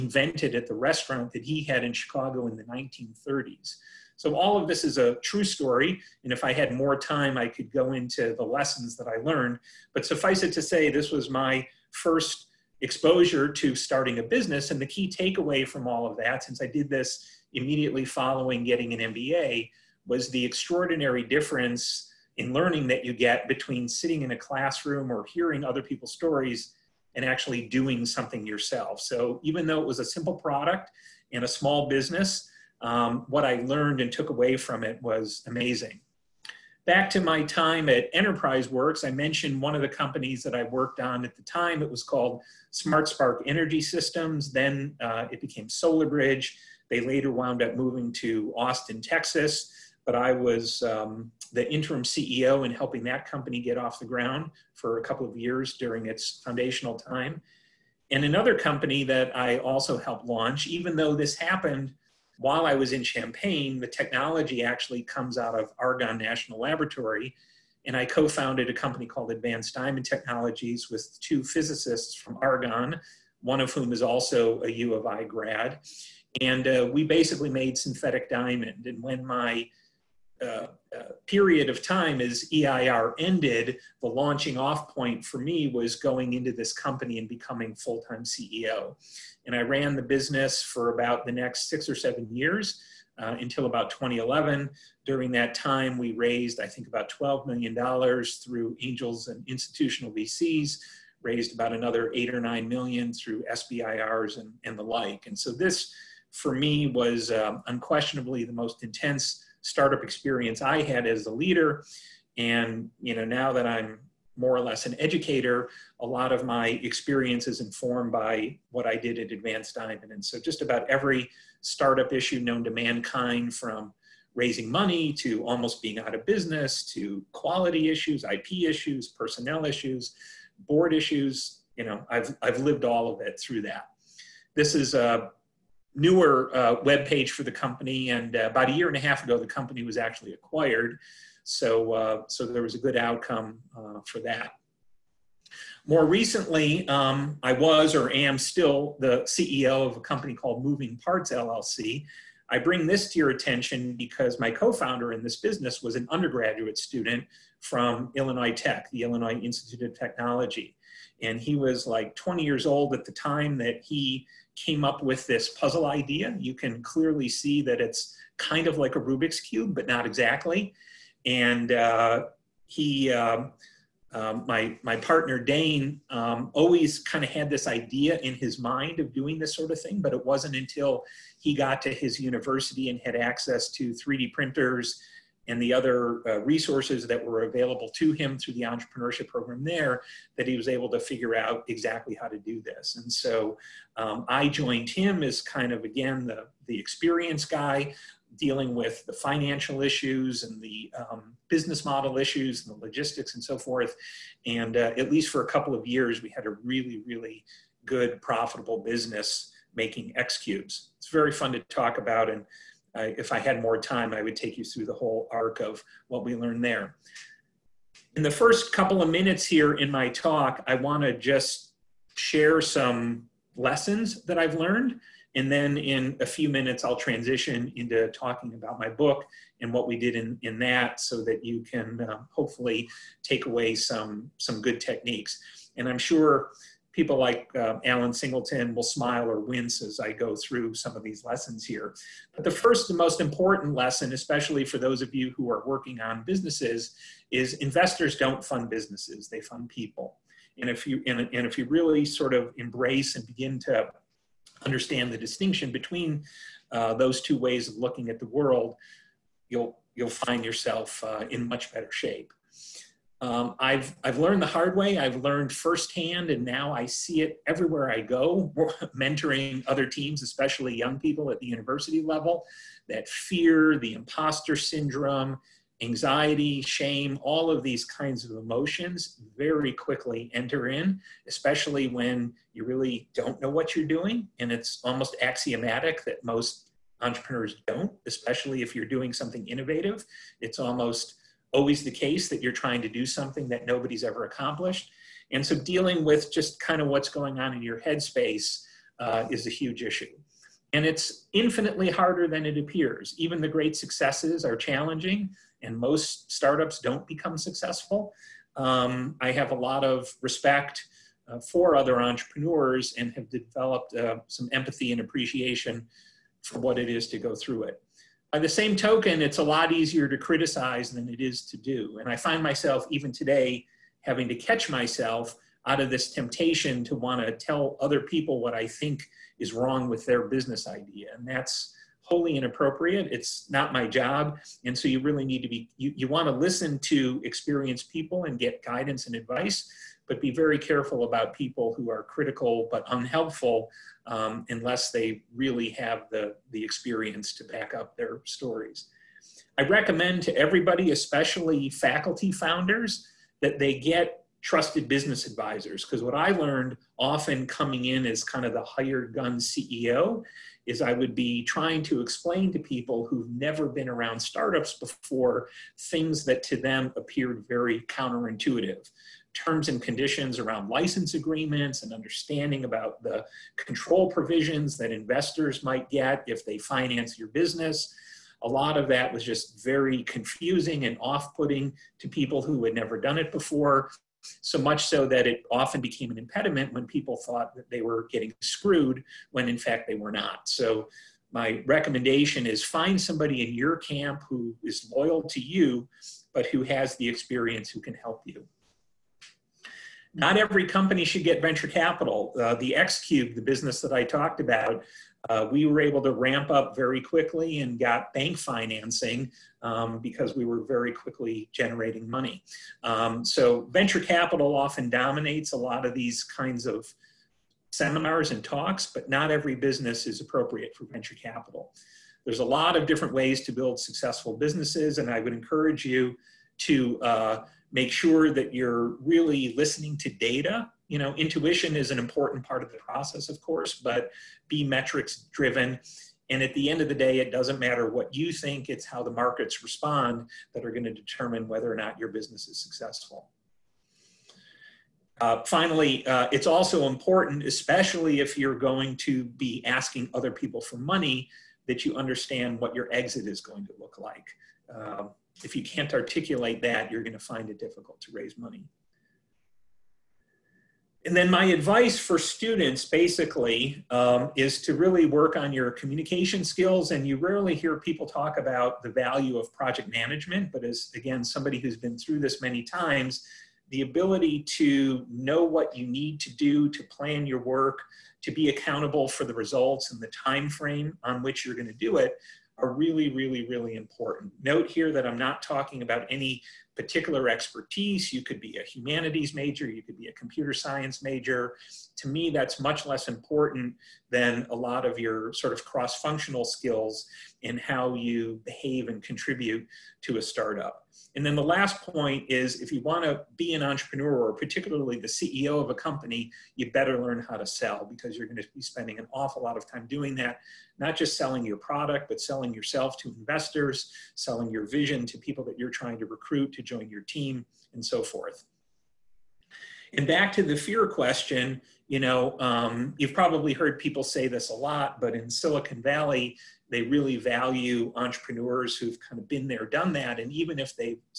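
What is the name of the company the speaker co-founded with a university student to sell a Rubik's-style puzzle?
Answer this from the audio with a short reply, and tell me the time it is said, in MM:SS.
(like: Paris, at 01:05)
Moving Parts LLC, at 02:30.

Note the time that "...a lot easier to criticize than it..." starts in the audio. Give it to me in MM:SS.
05:19.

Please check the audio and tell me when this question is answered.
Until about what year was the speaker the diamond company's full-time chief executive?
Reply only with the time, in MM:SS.
01:33.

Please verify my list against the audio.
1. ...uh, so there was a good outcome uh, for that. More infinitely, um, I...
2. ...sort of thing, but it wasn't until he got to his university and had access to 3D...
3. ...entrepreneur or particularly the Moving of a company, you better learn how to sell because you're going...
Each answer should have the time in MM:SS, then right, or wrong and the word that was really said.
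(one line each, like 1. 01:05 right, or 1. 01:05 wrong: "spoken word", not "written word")
1. 02:21 wrong: "recently", not "infinitely"
2. 02:59 right
3. 08:23 wrong: "CEO", not "Moving".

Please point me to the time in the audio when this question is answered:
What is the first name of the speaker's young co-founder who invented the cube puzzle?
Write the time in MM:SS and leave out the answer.
02:55.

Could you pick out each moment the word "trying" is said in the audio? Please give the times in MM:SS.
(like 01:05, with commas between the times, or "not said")
04:52, 06:01, 08:35.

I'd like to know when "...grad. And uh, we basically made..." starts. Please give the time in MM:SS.
01:15.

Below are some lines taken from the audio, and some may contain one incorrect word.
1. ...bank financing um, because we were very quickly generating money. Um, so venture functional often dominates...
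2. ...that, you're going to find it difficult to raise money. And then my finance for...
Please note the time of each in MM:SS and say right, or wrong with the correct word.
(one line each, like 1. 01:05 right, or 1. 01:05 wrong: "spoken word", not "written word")
1. 06:48 wrong: "capital", not "functional"
2. 07:36 wrong: "advice", not "finance".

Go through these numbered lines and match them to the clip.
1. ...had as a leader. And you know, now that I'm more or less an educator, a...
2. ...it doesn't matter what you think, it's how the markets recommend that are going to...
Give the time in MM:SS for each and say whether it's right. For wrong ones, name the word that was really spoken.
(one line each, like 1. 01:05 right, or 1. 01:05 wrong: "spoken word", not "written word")
1. 01:50 right
2. 07:17 wrong: "respond", not "recommend".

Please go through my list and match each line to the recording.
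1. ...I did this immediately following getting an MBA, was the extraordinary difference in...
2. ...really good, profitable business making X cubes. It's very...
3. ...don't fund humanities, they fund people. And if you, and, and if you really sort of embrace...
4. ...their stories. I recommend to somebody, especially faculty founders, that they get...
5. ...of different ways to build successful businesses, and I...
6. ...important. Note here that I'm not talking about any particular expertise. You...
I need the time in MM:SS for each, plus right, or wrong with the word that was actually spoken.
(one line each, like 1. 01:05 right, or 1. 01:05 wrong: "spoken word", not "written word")
1. 00:16 right
2. 03:27 right
3. 04:08 wrong: "businesses", not "humanities"
4. 05:47 wrong: "everybody", not "somebody"
5. 07:02 right
6. 08:03 right.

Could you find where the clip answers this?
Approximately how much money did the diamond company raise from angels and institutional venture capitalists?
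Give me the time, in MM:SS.
01:37.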